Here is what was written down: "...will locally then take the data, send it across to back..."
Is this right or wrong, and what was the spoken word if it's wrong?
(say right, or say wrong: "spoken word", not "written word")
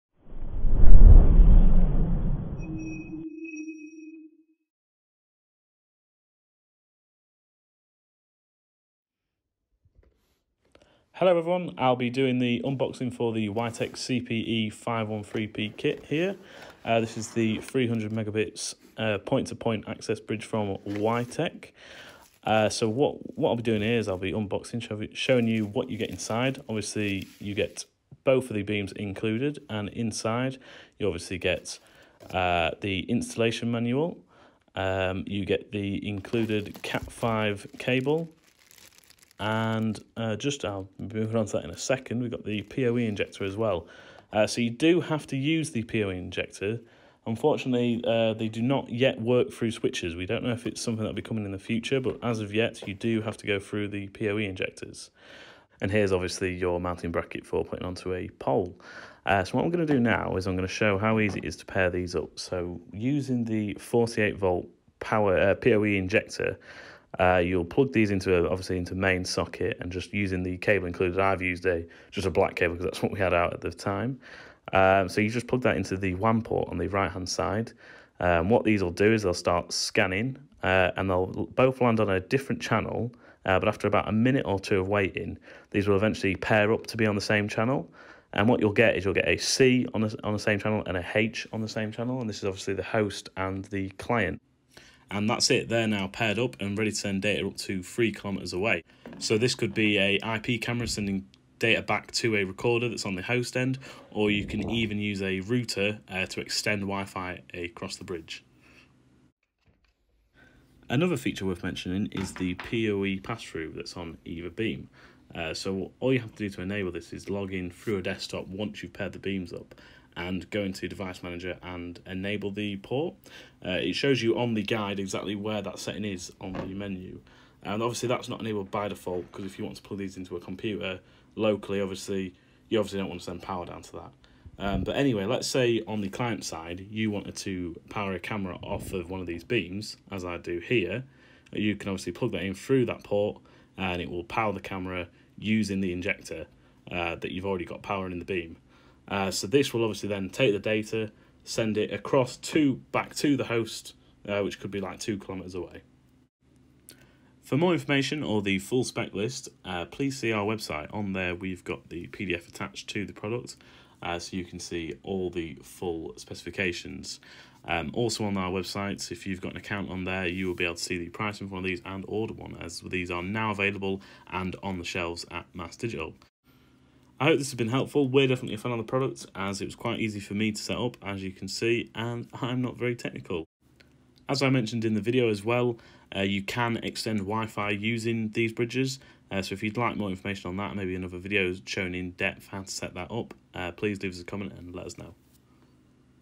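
wrong: "obviously", not "locally".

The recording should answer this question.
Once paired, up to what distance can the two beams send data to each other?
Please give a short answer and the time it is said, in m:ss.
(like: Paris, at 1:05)
3 kilometers, at 1:37.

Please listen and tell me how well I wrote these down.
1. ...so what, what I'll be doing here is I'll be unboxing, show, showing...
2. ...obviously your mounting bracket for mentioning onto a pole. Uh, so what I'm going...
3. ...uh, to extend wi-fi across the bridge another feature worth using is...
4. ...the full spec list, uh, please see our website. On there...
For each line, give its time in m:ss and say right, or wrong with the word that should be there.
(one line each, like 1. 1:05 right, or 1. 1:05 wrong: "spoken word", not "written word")
1. 0:22 right
2. 0:56 wrong: "putting", not "mentioning"
3. 1:46 wrong: "mentioning", not "using"
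4. 2:38 right.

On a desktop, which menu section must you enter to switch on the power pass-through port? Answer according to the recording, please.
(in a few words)
Device manager.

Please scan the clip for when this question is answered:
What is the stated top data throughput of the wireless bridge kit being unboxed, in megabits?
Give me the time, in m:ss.
0:17.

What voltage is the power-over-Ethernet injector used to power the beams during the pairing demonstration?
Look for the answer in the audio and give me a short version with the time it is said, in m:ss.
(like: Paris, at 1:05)
48 volt, at 1:03.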